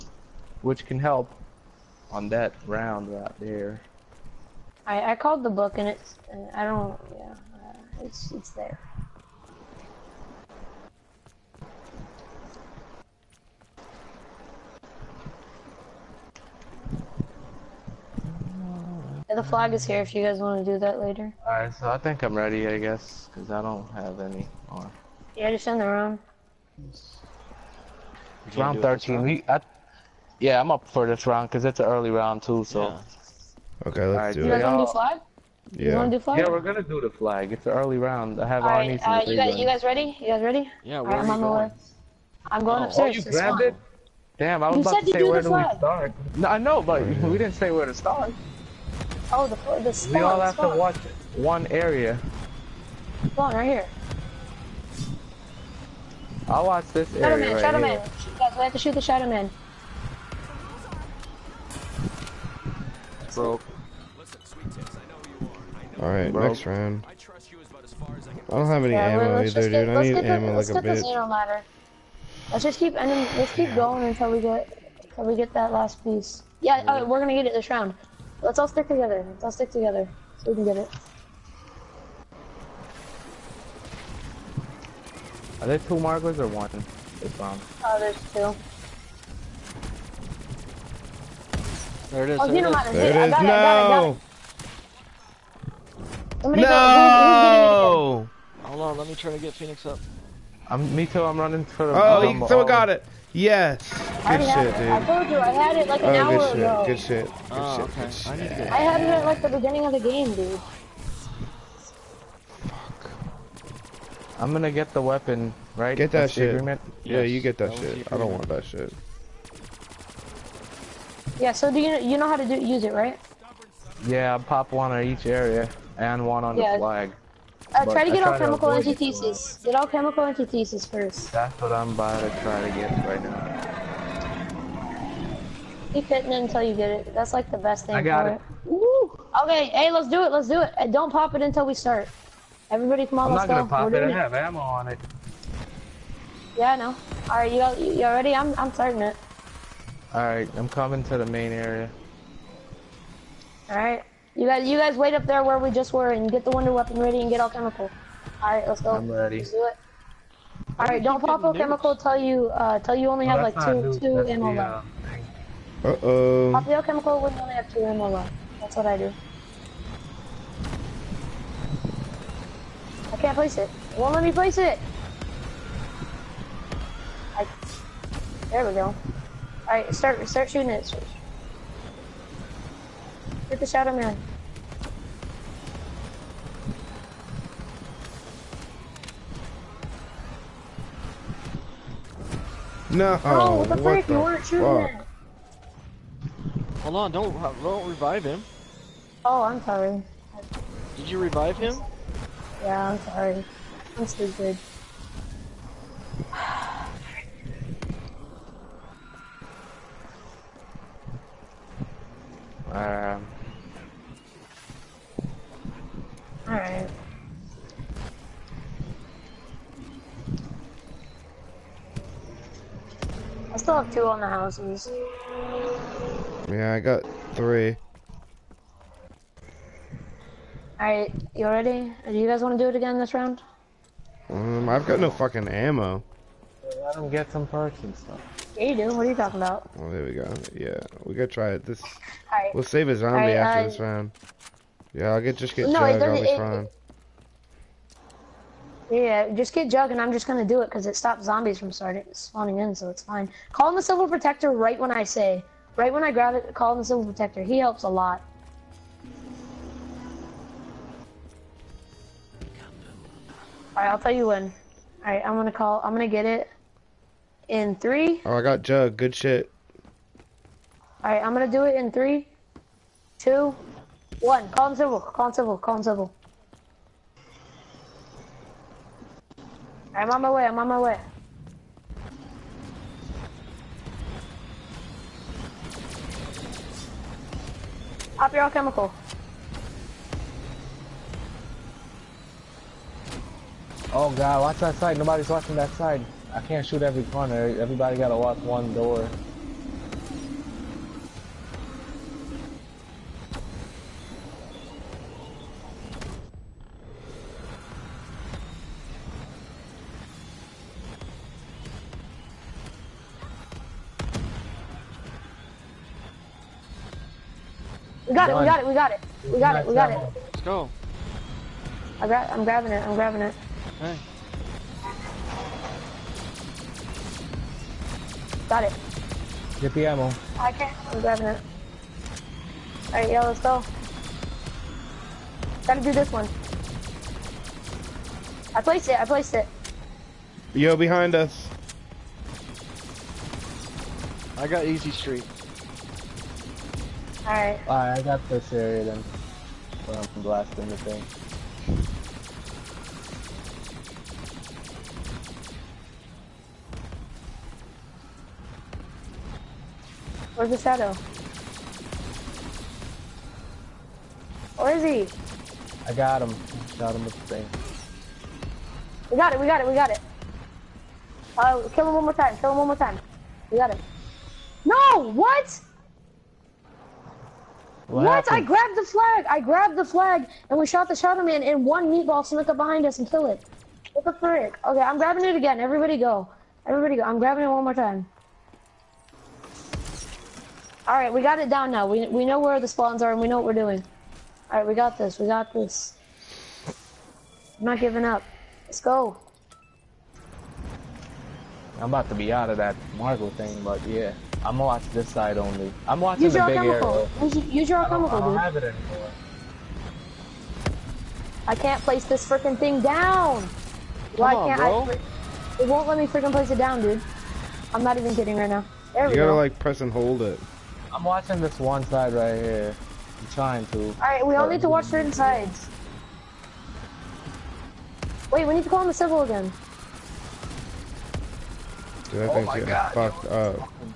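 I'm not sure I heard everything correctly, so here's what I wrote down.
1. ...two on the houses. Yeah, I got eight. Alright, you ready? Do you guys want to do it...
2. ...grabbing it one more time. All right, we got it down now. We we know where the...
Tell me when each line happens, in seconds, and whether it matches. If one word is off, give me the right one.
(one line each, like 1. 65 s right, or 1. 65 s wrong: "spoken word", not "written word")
1. 223 s wrong: "three", not "eight"
2. 387 s right.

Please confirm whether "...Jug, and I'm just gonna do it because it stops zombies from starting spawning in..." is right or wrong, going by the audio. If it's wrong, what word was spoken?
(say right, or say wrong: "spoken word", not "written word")
right.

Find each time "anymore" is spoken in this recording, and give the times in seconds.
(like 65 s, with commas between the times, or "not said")
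408 s.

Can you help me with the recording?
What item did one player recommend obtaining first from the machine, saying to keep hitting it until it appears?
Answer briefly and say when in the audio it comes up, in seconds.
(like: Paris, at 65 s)
Alchemical Antithesis, at 129 s.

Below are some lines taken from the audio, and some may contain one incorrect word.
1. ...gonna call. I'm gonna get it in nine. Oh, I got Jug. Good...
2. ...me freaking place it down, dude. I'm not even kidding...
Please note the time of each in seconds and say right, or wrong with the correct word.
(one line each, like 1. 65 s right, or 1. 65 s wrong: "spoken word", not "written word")
1. 265 s wrong: "three", not "nine"
2. 415 s right.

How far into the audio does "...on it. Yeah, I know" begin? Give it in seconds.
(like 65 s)
144 s.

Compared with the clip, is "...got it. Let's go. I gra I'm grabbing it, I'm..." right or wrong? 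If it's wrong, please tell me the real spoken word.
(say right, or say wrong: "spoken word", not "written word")
right.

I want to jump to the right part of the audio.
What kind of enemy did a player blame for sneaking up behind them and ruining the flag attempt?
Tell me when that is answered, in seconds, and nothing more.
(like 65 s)
381 s.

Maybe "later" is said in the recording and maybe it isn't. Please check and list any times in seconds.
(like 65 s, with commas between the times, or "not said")
20 s.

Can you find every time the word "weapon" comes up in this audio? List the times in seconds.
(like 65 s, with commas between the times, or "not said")
115 s, 156 s.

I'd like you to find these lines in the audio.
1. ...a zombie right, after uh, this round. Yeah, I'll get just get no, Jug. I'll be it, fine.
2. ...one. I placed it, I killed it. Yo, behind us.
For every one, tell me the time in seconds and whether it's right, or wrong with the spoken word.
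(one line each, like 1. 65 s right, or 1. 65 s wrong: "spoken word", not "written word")
1. 242 s right
2. 336 s wrong: "placed", not "killed".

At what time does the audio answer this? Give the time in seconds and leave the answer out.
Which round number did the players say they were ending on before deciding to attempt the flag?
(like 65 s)
26 s.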